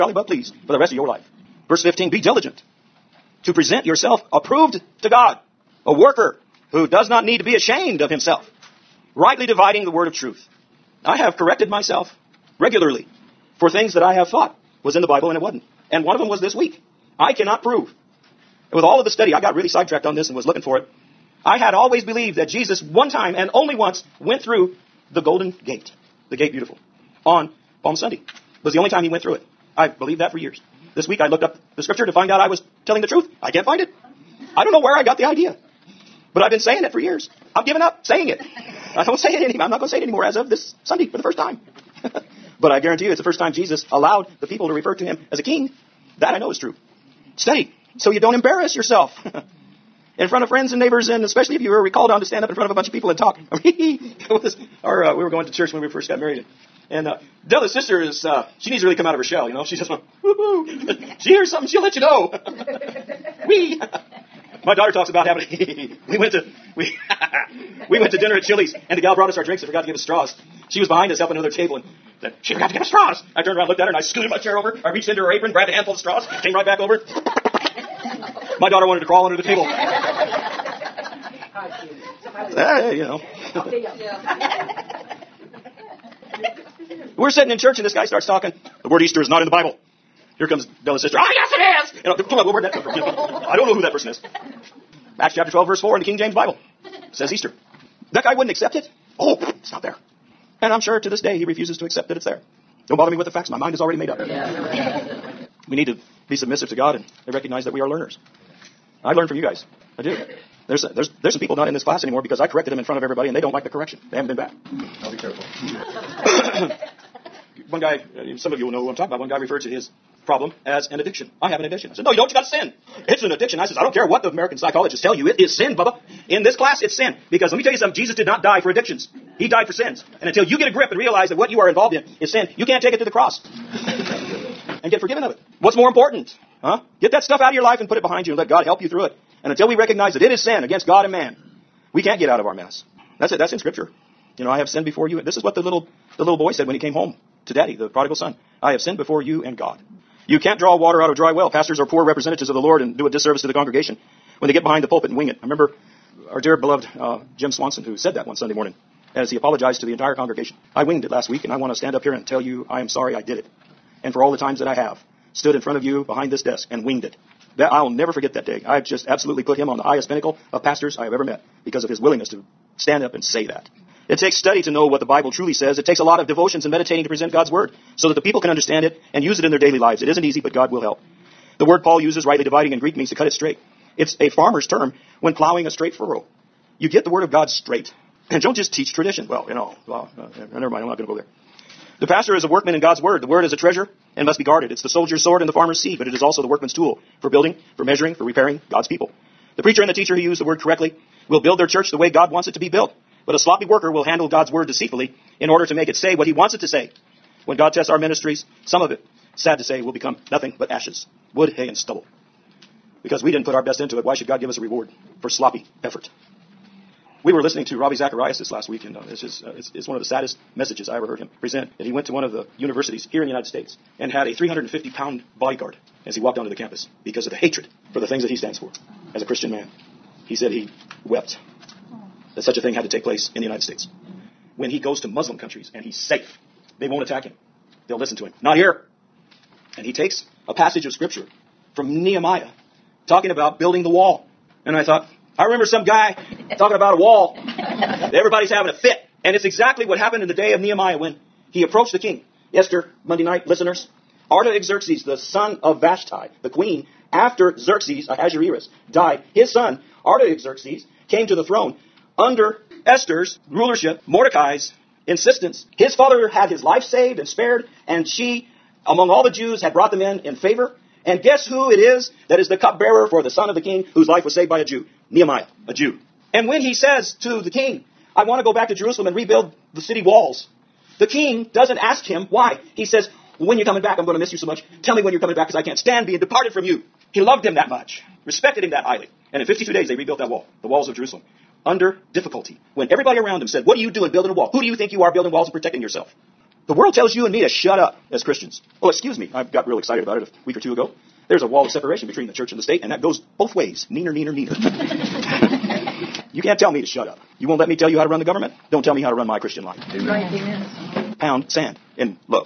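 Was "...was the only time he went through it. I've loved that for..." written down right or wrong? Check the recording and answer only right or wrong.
wrong.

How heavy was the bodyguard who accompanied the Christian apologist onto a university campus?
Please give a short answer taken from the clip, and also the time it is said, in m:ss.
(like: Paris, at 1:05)
350 pounds, at 3:44.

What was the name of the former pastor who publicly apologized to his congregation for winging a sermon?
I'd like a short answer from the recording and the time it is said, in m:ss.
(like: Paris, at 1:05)
Jim Swanson, at 2:37.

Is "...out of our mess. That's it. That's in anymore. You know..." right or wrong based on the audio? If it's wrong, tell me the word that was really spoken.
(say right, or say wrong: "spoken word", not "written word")
wrong: "scripture", not "anymore".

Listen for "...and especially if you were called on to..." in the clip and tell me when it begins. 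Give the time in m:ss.
0:51.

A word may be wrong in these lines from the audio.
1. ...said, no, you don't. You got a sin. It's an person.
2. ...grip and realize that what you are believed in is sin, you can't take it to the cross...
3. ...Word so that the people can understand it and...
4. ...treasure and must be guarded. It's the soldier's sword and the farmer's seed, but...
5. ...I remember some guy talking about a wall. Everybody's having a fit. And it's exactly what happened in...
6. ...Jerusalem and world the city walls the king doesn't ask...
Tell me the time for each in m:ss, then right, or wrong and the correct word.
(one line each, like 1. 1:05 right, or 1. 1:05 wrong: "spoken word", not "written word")
1. 2:01 wrong: "addiction", not "person"
2. 2:10 wrong: "involved", not "believed"
3. 2:57 right
4. 3:13 right
5. 4:05 right
6. 4:38 wrong: "rebuild", not "world".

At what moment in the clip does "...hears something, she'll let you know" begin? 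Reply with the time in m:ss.
1:01.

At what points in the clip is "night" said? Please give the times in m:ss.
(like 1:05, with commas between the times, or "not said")
4:13.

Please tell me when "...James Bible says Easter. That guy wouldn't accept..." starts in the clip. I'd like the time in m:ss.
1:36.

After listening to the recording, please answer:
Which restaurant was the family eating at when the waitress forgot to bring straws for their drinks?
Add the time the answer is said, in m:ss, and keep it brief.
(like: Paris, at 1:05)
Chili's, at 1:08.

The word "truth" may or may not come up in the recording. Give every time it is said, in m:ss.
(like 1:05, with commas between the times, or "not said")
0:10, 0:33.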